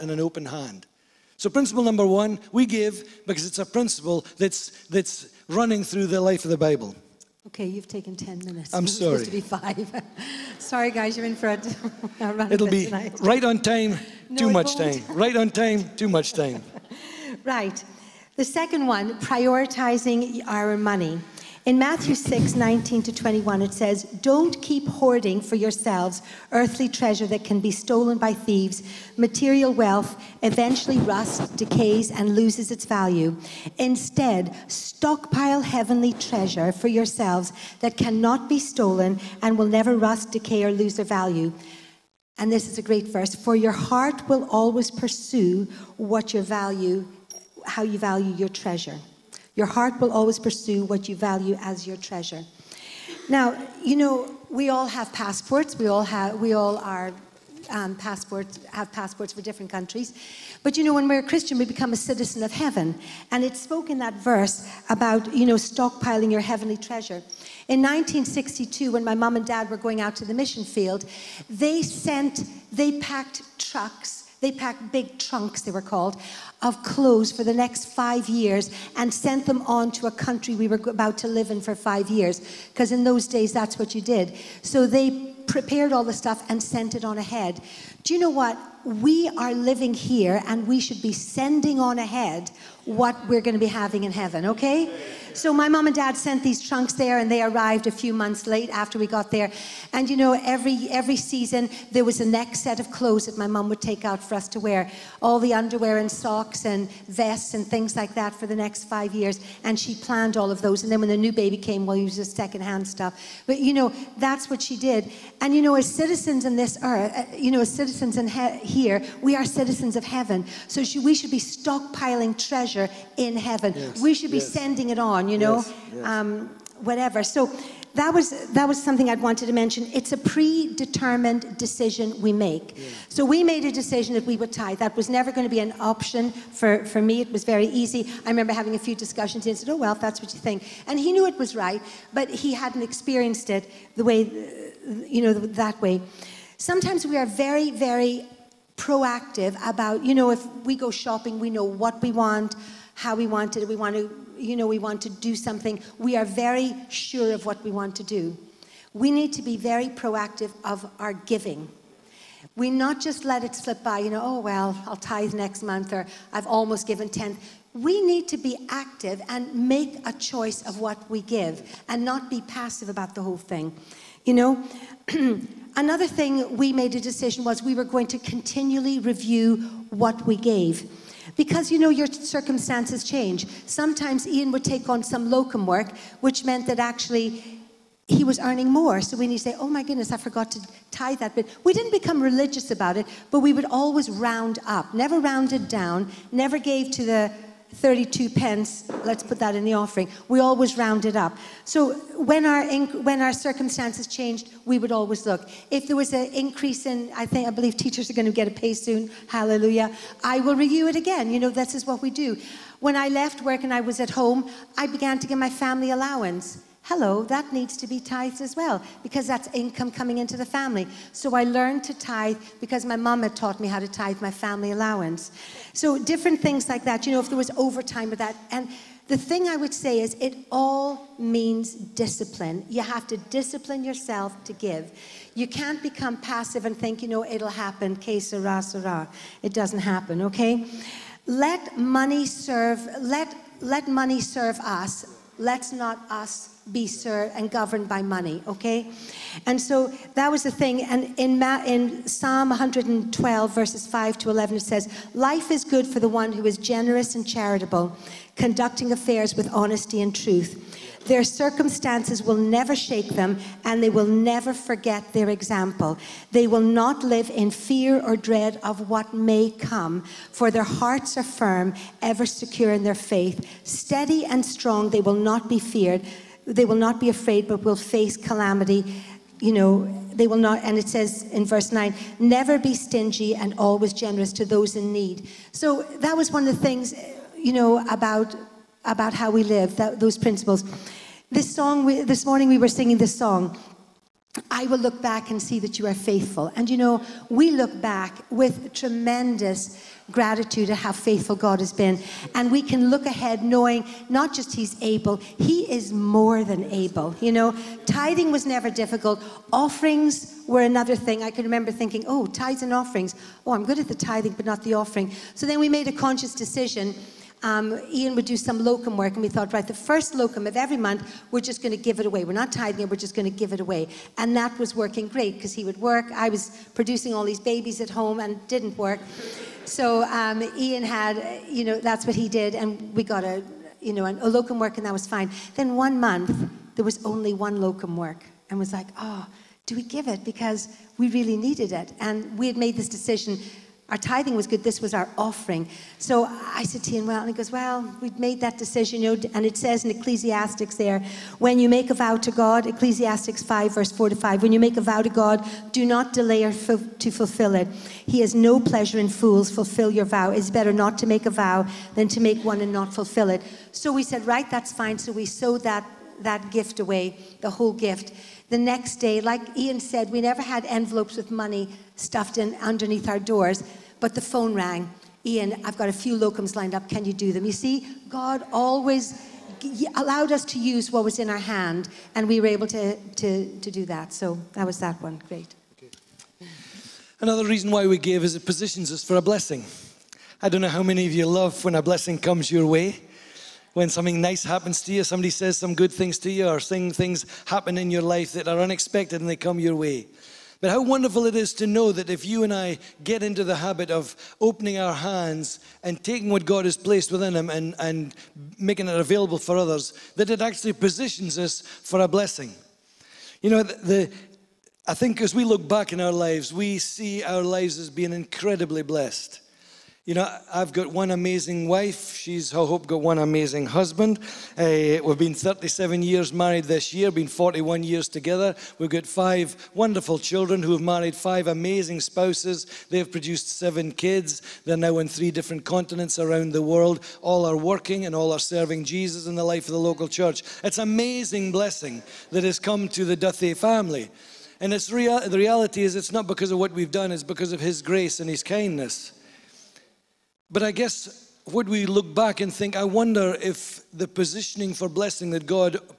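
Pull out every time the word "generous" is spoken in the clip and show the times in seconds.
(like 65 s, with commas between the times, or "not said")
256 s, 283 s.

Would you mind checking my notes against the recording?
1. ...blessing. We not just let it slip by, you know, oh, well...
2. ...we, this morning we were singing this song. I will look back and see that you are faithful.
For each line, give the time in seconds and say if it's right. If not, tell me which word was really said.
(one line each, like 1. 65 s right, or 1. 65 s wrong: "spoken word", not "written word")
1. 161 s wrong: "giving", not "blessing"
2. 291 s right.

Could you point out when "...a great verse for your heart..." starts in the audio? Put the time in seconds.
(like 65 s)
42 s.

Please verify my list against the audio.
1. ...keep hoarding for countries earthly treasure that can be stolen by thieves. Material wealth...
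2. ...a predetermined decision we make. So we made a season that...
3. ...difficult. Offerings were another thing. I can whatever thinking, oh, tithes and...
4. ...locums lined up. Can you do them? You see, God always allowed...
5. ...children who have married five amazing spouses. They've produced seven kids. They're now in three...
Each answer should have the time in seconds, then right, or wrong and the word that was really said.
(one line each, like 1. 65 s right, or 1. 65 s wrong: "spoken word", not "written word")
1. 24 s wrong: "yourselves", not "countries"
2. 130 s wrong: "decision", not "season"
3. 308 s wrong: "remember", not "whatever"
4. 376 s right
5. 430 s right.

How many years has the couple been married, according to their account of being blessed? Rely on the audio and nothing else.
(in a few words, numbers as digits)
37.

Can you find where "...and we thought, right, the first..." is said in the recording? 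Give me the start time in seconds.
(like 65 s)
319 s.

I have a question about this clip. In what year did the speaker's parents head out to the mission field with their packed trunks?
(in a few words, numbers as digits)
1962.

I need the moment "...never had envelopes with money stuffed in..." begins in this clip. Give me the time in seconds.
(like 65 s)
370 s.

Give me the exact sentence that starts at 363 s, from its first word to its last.
So we said, right, that's fine.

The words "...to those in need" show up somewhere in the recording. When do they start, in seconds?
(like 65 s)
284 s.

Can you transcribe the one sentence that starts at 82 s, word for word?
Because in those days, that's what you did.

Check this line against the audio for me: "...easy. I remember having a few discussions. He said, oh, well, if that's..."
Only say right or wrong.
right.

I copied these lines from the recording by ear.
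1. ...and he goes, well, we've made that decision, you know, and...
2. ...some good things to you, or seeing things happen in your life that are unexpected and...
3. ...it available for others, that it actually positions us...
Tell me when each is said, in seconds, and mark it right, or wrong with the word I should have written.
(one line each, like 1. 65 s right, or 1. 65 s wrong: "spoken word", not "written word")
1. 347 s right
2. 395 s right
3. 408 s right.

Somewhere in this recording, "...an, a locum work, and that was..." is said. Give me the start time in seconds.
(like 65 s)
334 s.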